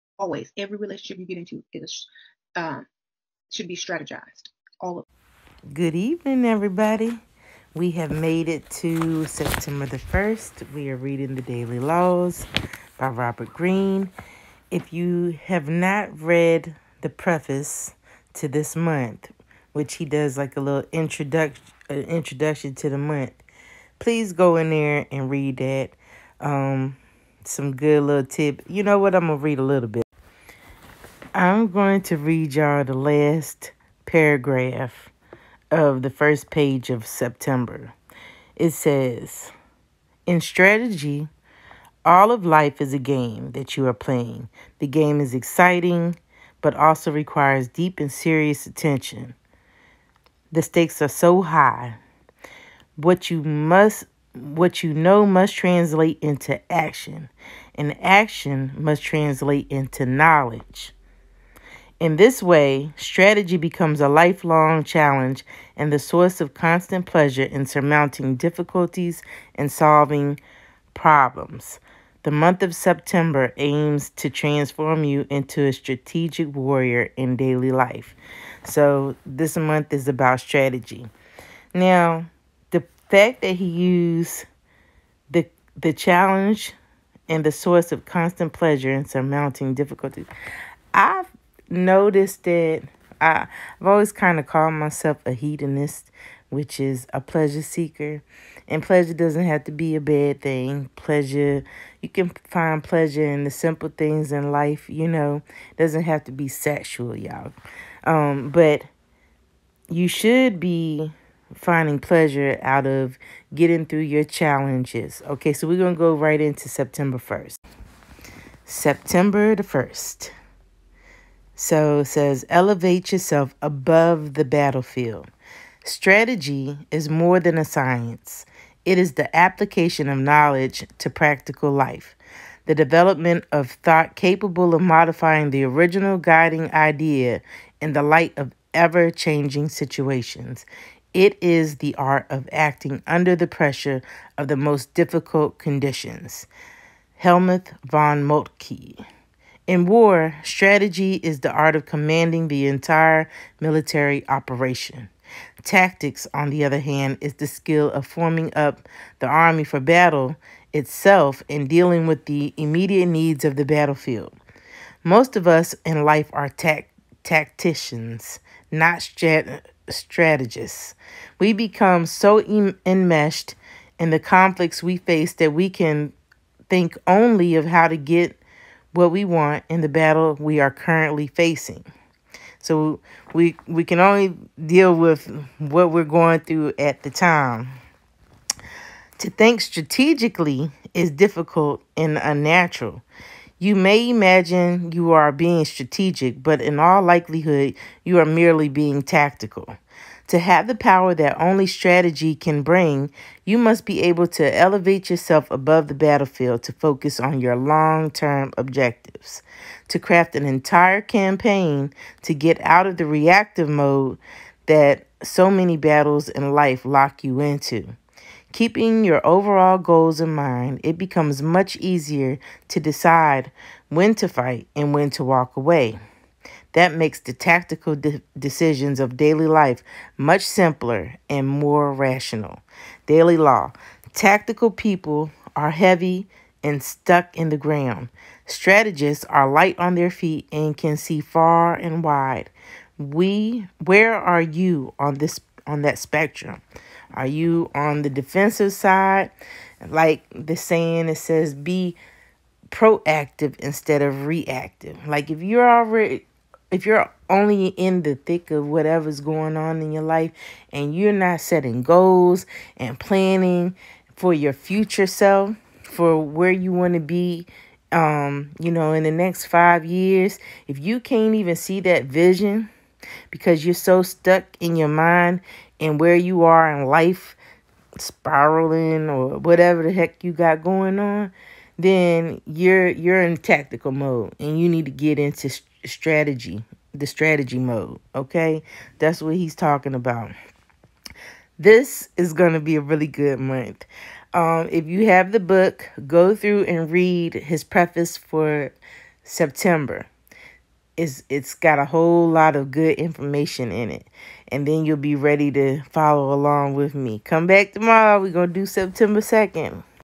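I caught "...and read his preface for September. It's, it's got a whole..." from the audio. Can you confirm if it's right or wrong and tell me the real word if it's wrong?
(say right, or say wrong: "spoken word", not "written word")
right.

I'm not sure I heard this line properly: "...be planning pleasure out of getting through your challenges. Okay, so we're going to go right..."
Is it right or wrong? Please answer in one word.
wrong.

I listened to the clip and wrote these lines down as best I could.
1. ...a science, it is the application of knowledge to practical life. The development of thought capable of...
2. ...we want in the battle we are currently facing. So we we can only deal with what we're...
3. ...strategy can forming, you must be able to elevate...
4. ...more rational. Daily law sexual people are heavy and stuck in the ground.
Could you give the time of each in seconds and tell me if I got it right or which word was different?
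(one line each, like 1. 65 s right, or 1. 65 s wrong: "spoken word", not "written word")
1. 127 s right
2. 179 s right
3. 201 s wrong: "bring", not "forming"
4. 231 s wrong: "tactical", not "sexual".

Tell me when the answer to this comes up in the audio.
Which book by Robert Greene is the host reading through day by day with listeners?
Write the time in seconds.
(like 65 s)
11 s.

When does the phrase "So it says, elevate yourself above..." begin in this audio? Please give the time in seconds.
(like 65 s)
121 s.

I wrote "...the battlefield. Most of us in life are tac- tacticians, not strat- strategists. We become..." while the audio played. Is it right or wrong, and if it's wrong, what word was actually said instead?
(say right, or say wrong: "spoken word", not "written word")
right.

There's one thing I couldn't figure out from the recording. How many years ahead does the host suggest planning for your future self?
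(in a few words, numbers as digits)
5.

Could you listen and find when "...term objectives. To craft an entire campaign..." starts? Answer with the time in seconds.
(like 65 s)
208 s.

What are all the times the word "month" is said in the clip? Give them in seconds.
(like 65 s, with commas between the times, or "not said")
18 s, 22 s, 72 s, 79 s, 293 s.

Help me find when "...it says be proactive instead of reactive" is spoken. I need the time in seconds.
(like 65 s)
251 s.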